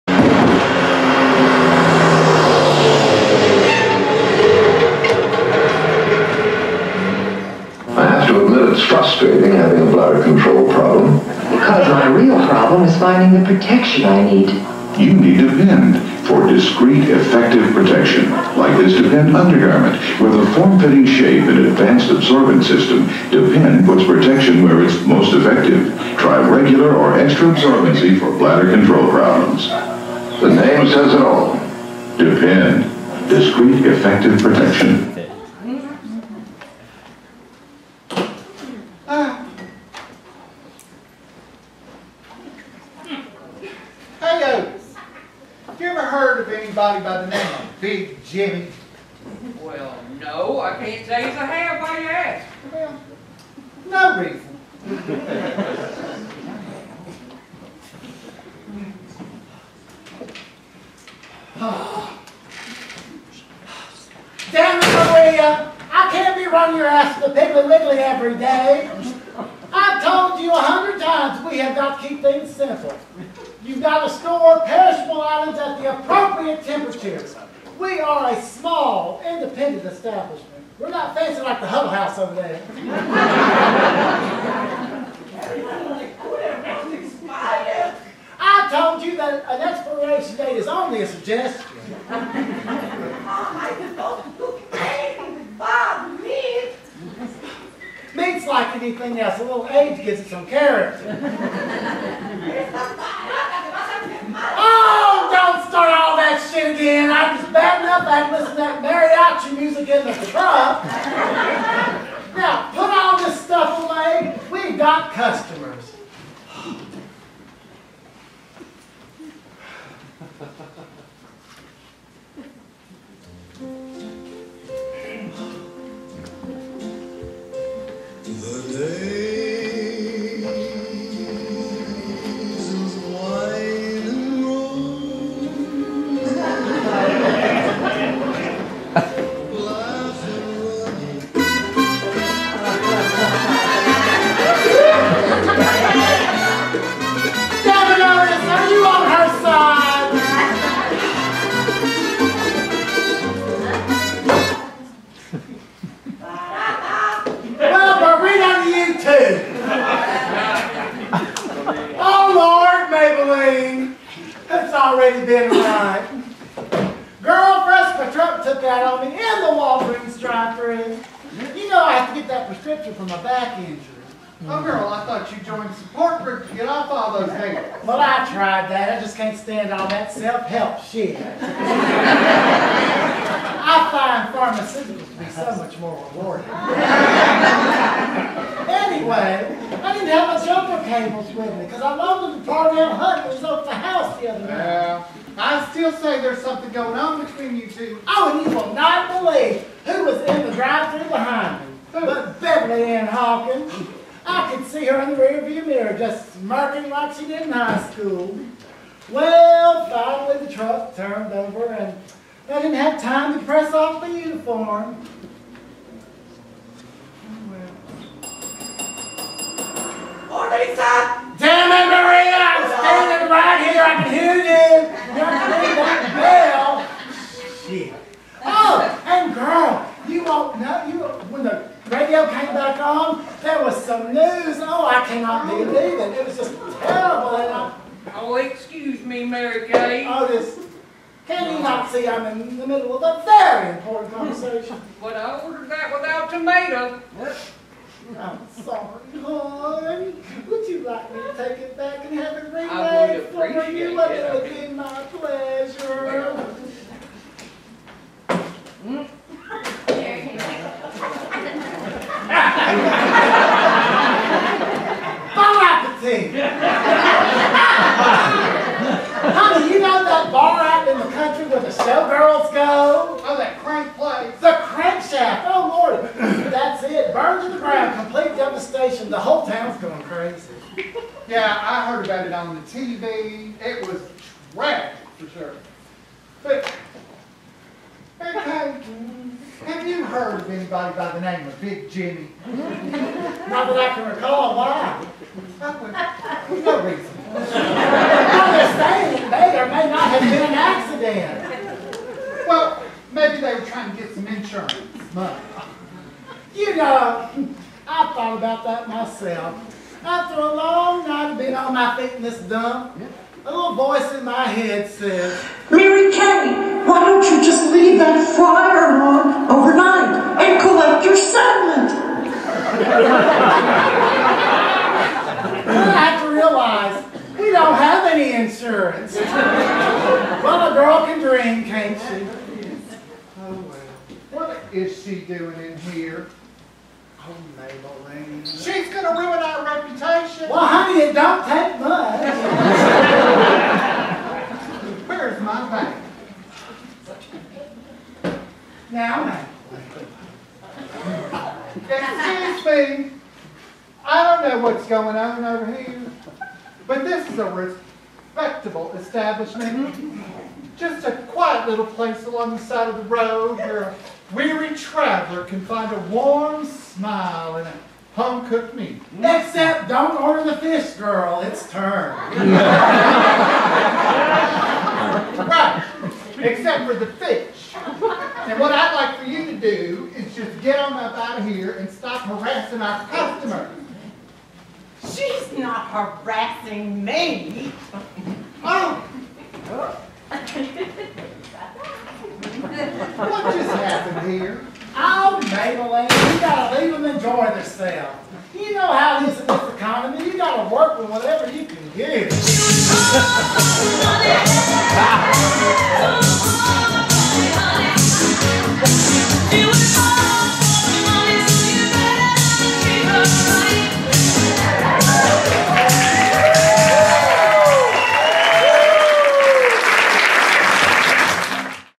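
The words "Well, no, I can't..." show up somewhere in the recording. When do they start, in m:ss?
0:49.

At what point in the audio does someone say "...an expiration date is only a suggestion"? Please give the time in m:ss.
1:29.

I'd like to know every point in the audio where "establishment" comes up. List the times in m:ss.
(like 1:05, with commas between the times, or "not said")
1:19, 5:58.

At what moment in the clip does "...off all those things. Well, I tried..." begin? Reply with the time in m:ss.
2:56.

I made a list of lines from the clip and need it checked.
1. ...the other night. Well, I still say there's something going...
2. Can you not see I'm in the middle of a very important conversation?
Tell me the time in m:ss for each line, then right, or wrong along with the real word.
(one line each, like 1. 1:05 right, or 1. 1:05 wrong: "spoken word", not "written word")
1. 3:14 right
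2. 4:01 right.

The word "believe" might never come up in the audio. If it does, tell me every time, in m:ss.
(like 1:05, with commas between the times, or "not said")
3:19, 3:55.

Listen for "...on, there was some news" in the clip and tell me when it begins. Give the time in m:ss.
3:52.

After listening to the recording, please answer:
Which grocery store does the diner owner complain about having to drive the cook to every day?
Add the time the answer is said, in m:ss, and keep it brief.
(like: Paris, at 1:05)
Piggly Wiggly, at 1:07.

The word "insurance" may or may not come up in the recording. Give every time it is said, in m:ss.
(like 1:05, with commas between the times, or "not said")
5:04, 5:28.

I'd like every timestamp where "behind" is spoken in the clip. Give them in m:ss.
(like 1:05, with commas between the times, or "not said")
3:21.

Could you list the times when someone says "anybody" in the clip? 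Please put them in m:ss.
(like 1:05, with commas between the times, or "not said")
0:46, 4:50.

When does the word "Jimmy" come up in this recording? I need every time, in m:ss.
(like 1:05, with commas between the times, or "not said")
0:48, 4:51.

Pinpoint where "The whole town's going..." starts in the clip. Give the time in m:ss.
4:39.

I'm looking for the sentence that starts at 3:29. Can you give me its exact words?
Well, finally the truck turned over and I didn't have time to press off the uniform.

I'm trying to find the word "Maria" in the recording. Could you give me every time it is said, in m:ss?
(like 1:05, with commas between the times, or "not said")
1:04, 3:41.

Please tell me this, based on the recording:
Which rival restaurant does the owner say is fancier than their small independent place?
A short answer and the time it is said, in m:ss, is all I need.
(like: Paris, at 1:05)
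Huddle House, at 1:21.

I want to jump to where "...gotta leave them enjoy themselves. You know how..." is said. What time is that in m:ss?
6:36.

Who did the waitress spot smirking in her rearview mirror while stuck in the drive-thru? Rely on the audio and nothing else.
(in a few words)
Beverly Ann Hawkins.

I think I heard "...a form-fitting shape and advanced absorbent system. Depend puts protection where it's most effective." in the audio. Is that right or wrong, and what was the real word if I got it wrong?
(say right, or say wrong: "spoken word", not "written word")
right.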